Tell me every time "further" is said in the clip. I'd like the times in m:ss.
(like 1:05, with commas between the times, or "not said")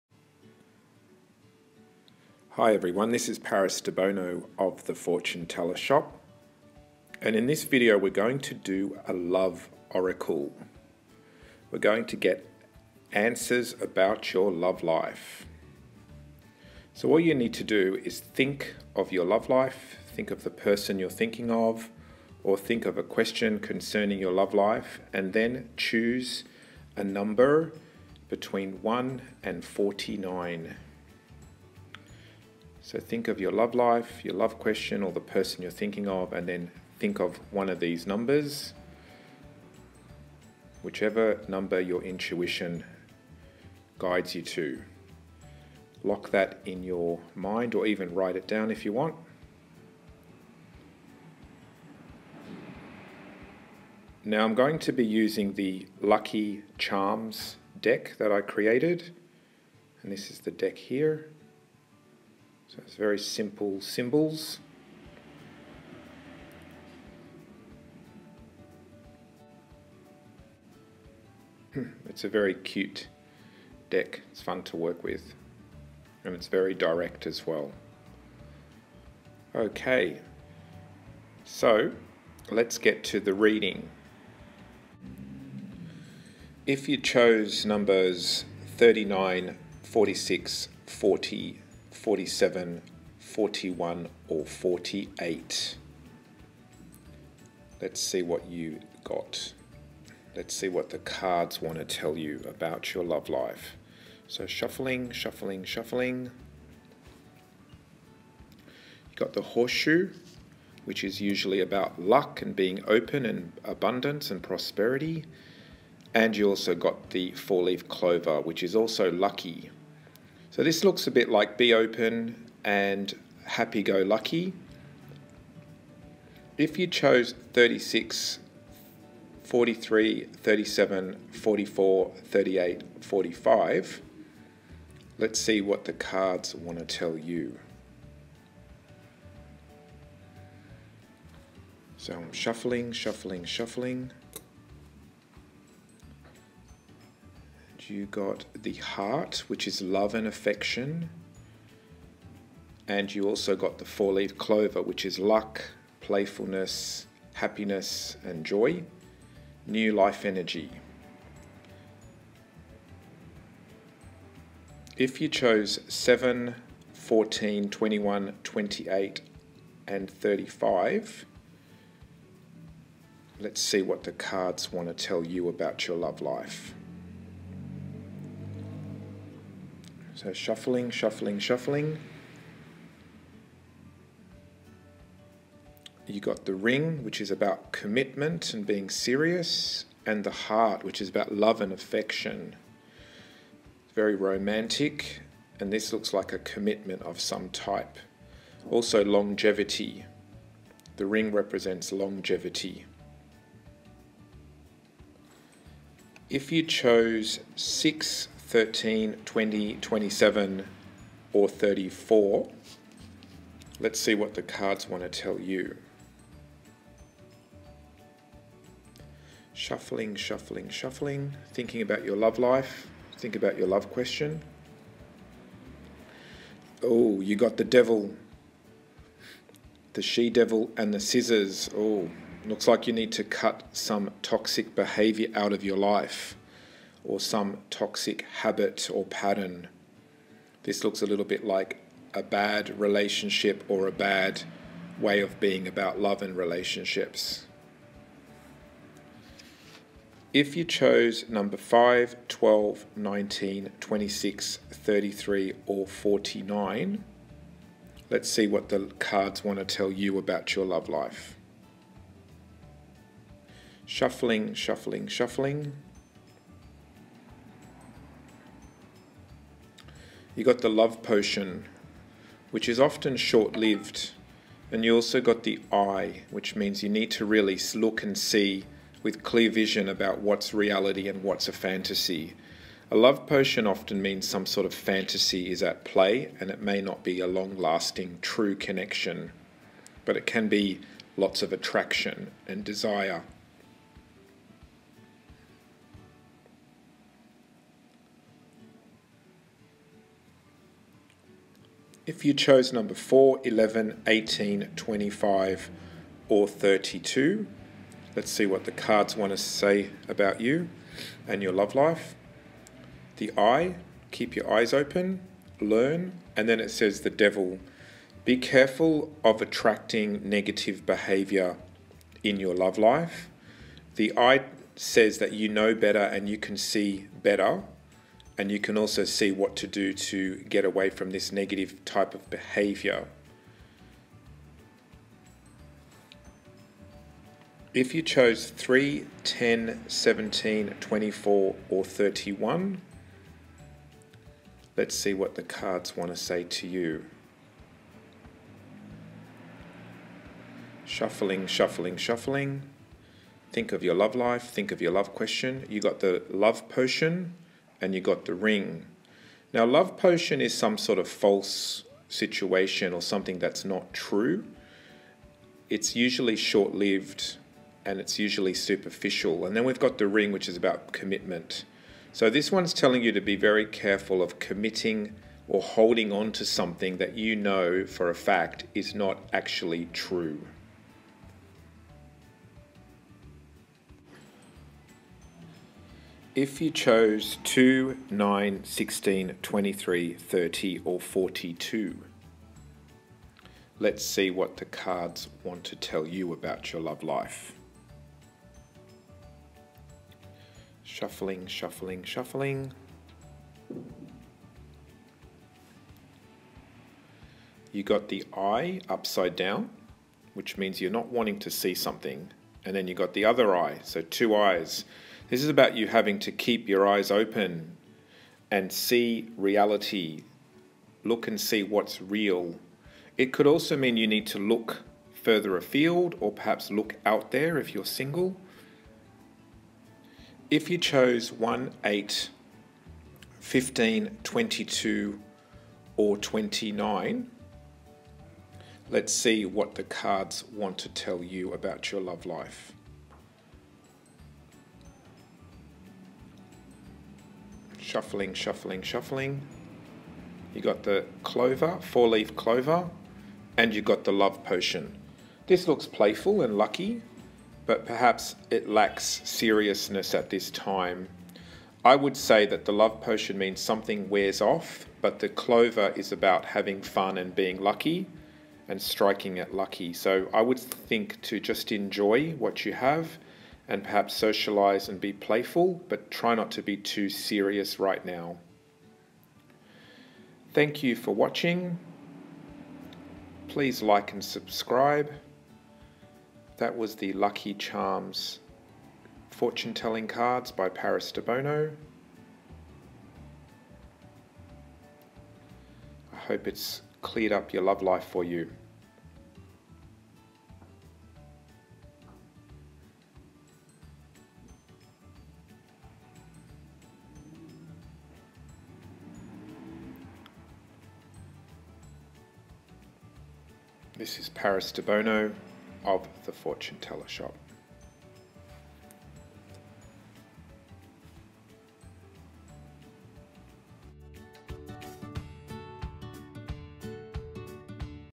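7:05.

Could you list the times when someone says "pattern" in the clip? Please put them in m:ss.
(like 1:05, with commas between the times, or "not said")
3:59.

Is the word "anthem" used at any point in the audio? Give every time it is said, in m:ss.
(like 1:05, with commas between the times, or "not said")
not said.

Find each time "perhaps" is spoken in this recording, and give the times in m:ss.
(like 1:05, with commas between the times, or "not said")
7:06, 7:37, 7:53.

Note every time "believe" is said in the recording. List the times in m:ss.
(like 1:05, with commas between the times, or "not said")
not said.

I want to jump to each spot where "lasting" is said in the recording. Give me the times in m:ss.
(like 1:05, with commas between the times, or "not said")
4:47.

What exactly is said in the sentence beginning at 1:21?
So, let's get to the reading.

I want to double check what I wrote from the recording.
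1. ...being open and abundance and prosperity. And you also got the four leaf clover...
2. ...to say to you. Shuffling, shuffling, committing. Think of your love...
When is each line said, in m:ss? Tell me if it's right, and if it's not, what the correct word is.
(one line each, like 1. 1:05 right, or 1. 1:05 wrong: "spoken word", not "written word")
1. 1:52 right
2. 5:46 wrong: "shuffling", not "committing".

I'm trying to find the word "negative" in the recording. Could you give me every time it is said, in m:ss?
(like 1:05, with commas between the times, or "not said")
5:20, 5:31.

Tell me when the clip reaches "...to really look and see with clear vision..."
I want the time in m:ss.
4:37.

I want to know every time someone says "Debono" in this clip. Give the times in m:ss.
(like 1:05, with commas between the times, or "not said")
0:03, 8:11, 8:34.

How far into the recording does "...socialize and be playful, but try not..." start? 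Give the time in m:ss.
7:54.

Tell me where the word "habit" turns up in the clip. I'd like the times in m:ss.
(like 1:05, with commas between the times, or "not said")
3:58.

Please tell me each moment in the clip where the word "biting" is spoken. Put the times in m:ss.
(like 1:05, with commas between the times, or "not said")
not said.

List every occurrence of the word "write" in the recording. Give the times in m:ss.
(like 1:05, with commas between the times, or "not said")
0:48.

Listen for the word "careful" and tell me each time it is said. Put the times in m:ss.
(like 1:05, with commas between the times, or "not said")
5:18, 6:13.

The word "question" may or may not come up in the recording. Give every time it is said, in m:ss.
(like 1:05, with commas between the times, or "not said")
0:23, 0:34, 3:43, 5:55.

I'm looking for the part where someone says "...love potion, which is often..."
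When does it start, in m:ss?
4:30.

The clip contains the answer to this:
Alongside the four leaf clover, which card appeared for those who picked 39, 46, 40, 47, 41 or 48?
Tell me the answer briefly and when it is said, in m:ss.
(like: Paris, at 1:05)
horseshoe, at 1:49.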